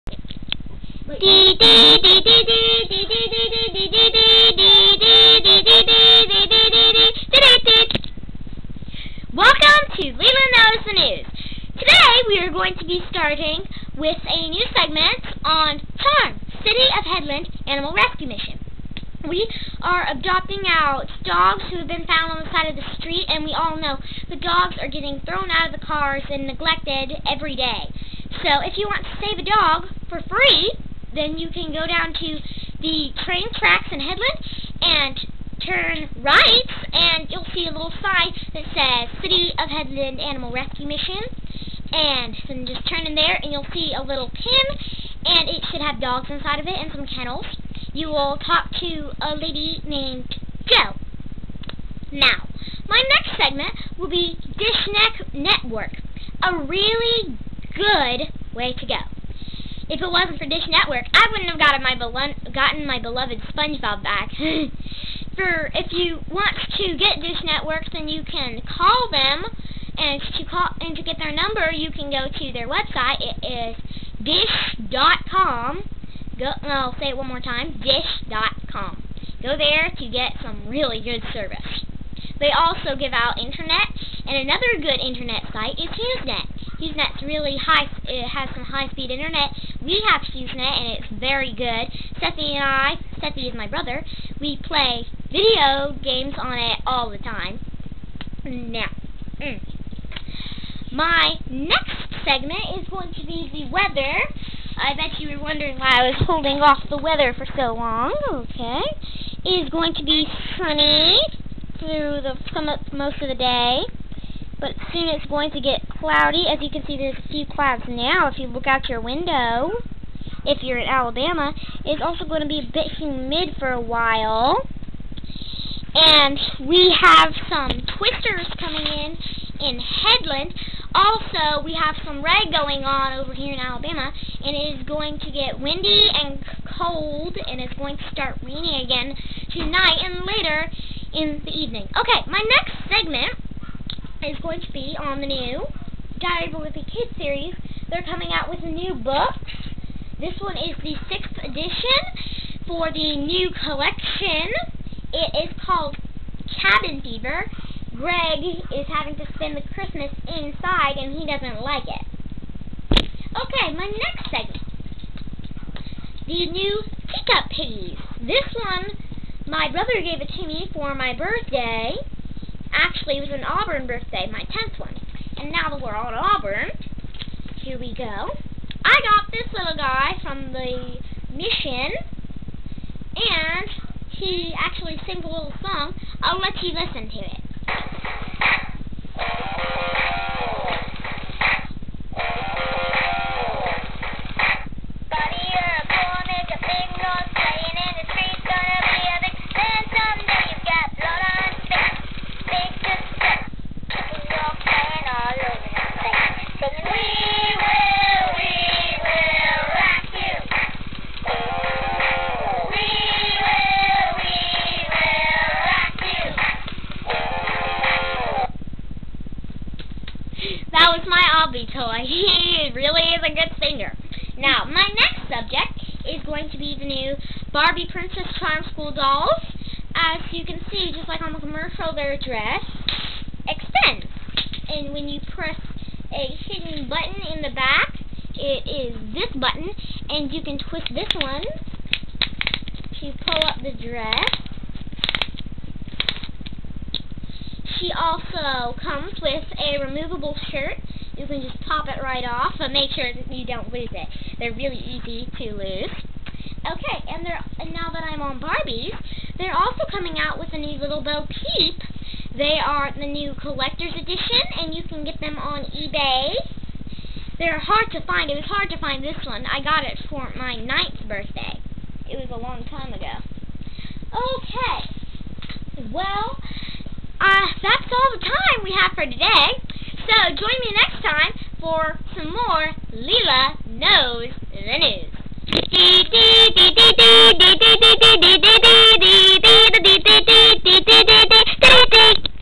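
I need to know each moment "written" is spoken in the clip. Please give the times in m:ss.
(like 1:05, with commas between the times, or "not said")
not said.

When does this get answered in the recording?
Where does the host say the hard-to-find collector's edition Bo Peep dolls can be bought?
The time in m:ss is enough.
4:25.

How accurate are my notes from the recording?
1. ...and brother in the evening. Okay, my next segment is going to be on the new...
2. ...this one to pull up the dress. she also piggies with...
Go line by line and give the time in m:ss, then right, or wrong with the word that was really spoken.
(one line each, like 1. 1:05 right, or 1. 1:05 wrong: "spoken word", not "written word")
1. 2:20 wrong: "later", not "brother"
2. 4:00 wrong: "comes", not "piggies".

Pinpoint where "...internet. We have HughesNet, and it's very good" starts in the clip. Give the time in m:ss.
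1:29.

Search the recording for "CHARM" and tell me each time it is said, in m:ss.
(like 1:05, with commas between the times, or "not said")
0:15, 3:48.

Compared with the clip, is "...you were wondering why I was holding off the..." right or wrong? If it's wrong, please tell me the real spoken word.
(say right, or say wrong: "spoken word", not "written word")
right.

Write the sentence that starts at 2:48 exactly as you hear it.
This one, my brother gave it to me for my birthday.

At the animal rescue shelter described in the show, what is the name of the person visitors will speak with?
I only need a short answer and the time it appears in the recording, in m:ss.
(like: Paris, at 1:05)
Joe, at 0:50.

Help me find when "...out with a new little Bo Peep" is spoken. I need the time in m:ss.
4:20.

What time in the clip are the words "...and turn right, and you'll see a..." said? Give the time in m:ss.
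0:34.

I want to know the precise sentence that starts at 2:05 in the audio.
And we have some twisters coming in in Headland.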